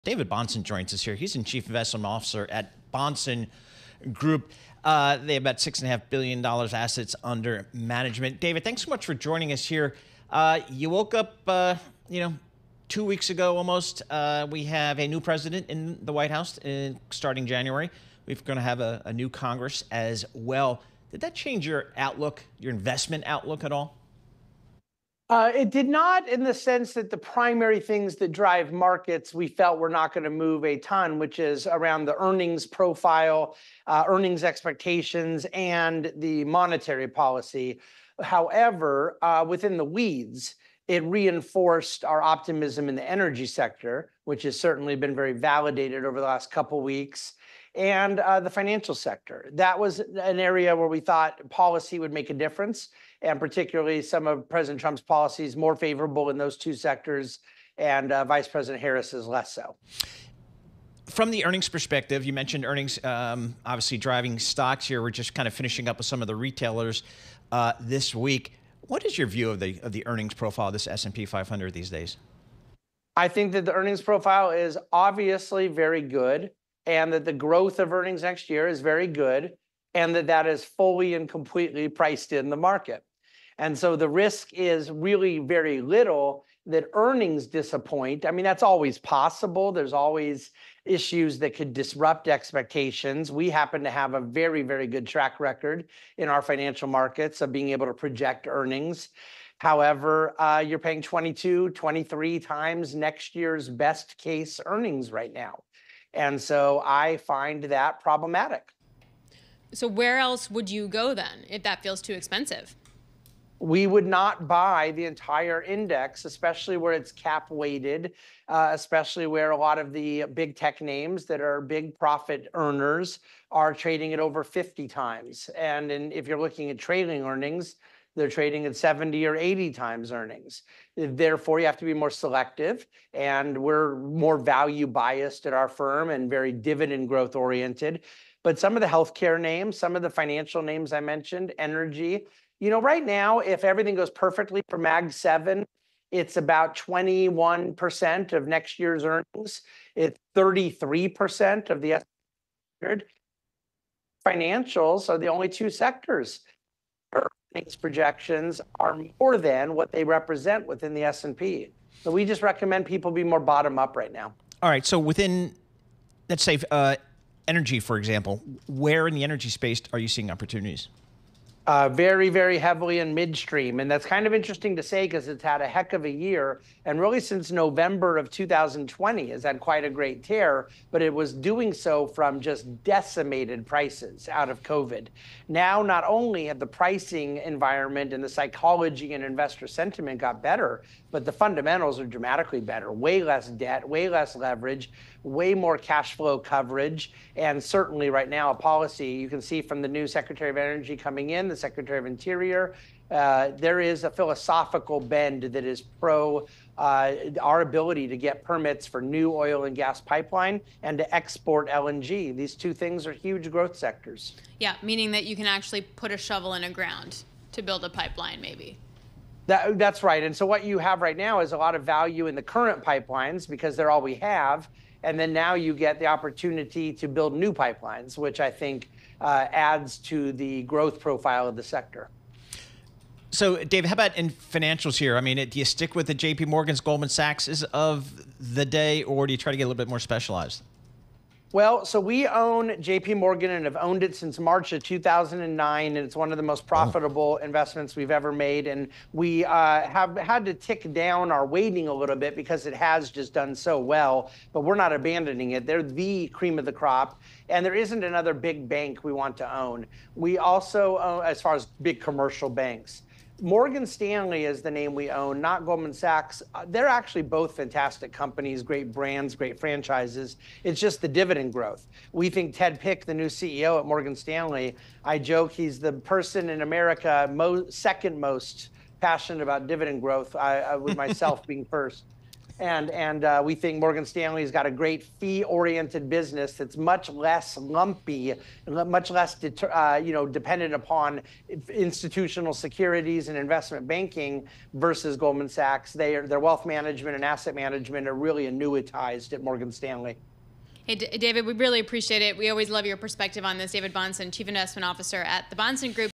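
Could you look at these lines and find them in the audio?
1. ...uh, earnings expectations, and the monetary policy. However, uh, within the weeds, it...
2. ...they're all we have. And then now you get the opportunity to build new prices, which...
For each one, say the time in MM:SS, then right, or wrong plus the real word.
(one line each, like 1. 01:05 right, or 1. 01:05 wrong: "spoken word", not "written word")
1. 00:33 right
2. 03:43 wrong: "pipelines", not "prices".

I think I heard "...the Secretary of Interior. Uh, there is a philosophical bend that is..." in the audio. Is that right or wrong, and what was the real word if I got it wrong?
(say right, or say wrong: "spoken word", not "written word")
right.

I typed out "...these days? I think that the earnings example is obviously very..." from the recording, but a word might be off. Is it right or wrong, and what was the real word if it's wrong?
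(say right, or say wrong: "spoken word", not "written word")
wrong: "profile", not "example".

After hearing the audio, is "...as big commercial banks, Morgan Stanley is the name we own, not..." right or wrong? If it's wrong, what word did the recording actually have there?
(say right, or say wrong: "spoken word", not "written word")
right.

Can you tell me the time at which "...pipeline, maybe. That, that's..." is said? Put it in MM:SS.
03:37.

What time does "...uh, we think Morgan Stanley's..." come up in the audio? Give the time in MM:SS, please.
04:43.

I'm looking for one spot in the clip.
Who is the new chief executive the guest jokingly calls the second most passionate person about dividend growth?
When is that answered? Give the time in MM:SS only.
04:32.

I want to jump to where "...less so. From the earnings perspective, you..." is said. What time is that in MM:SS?
00:59.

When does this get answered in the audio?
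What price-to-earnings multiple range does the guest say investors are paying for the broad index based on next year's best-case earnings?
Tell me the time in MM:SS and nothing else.
01:41.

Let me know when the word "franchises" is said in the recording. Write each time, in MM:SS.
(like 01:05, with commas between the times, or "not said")
04:29.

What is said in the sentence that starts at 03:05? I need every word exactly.
Now, not only have the pricing environment and the psychology and investor sentiment got better, but the fundamentals are dramatically better.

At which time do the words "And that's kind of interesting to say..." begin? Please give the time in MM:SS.
02:53.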